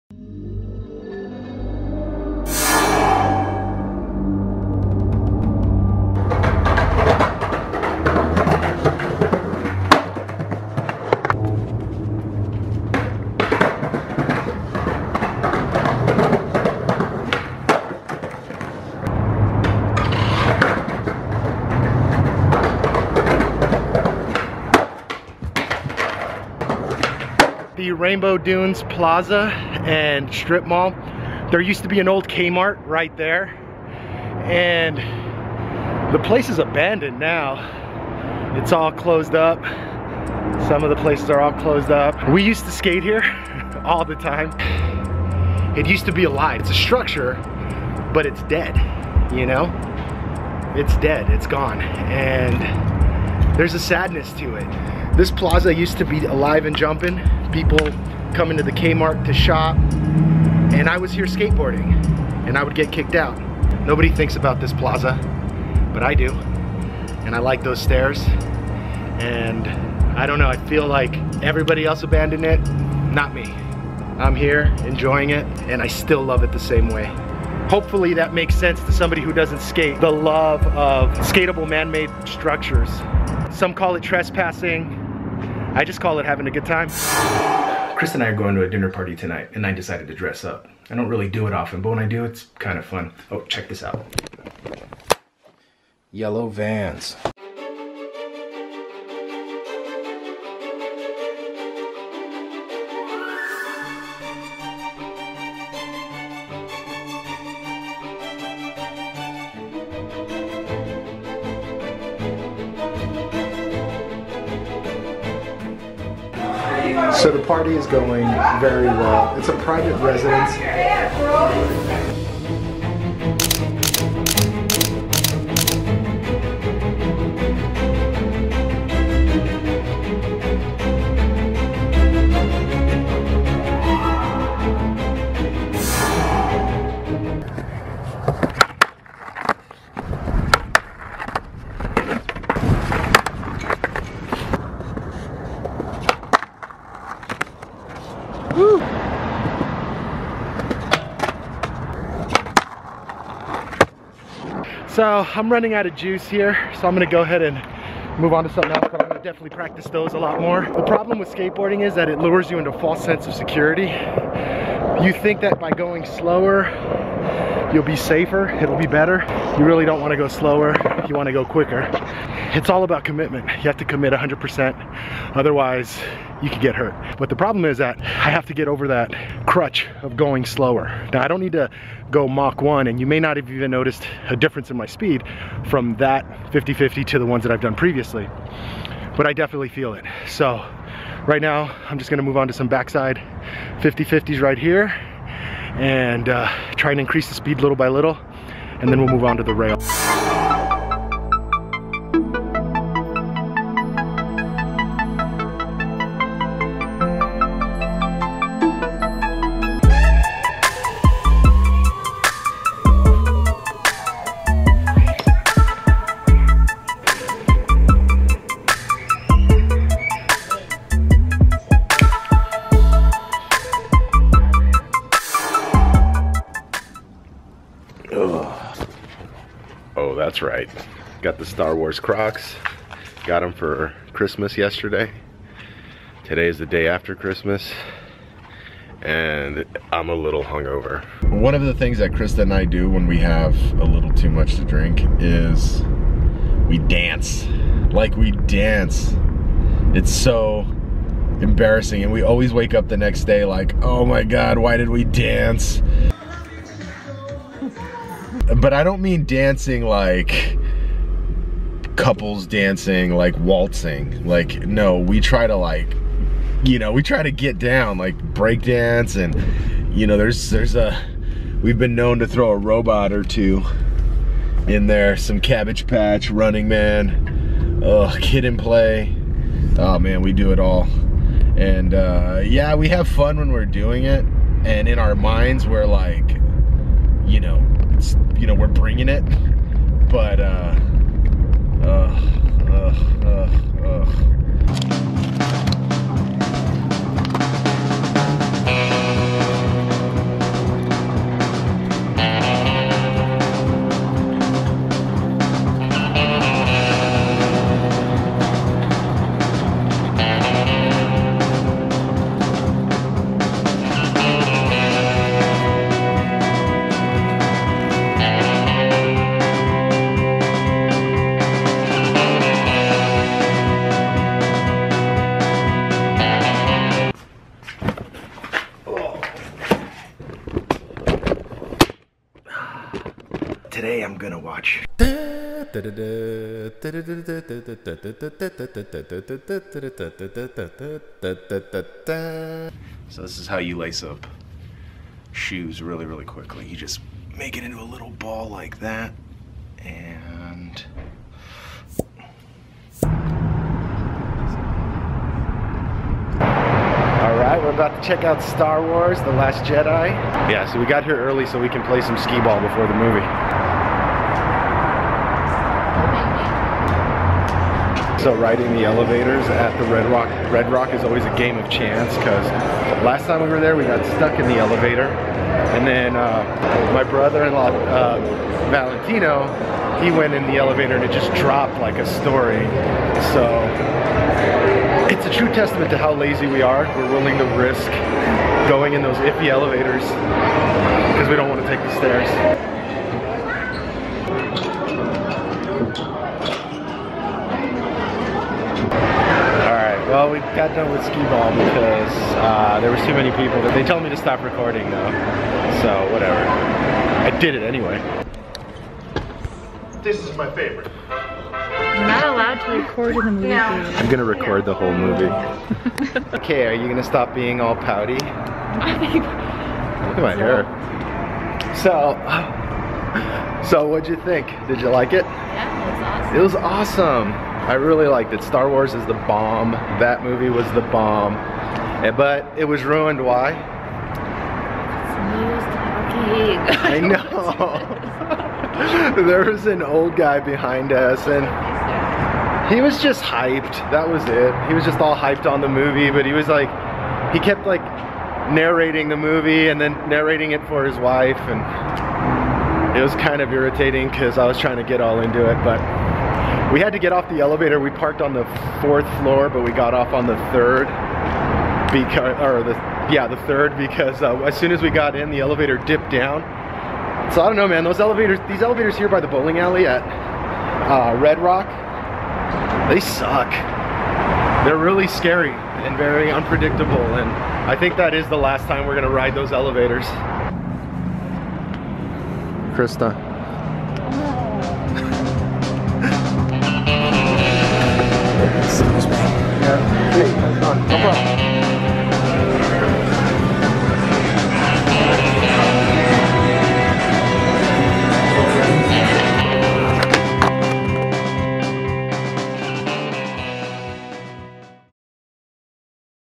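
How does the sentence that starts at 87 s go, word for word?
Chris and I are going to a dinner party tonight, and I decided to dress up.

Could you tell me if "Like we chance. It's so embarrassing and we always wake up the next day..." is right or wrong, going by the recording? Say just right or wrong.
wrong.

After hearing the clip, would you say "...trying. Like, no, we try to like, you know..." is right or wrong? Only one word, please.
wrong.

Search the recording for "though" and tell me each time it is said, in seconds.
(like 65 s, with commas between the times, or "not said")
404 s.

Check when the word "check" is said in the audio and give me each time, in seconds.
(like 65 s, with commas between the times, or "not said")
93 s, 358 s.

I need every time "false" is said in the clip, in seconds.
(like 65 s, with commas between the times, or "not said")
162 s.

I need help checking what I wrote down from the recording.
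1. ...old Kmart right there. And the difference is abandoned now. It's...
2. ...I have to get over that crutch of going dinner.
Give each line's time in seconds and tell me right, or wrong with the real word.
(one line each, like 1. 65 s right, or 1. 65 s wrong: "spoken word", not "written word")
1. 32 s wrong: "place", not "difference"
2. 178 s wrong: "slower", not "dinner".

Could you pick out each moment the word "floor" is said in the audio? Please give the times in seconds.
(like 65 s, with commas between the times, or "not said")
459 s.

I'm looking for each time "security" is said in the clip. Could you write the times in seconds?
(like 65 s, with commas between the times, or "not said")
163 s.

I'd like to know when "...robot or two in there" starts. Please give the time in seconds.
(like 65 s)
272 s.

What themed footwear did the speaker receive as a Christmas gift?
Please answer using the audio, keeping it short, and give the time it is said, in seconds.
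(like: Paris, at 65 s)
Star Wars Crocs, at 231 s.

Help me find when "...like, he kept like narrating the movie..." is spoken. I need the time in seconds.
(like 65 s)
446 s.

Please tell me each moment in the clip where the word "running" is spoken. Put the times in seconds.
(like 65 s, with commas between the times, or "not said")
155 s, 276 s.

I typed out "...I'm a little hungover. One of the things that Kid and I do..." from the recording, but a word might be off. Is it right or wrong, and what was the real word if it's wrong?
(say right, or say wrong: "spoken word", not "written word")
wrong: "Krista", not "Kid".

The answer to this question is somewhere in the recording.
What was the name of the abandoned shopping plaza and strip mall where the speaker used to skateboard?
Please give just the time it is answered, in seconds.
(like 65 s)
27 s.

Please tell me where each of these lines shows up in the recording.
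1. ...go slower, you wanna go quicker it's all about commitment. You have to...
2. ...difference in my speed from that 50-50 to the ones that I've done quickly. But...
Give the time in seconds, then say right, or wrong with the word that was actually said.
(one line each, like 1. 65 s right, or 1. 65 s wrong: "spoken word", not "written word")
1. 170 s right
2. 184 s wrong: "previously", not "quickly".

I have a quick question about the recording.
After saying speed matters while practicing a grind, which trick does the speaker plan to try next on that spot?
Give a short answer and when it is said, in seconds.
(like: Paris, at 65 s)
backside 50-50s, at 192 s.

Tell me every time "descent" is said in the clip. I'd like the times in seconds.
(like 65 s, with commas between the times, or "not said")
not said.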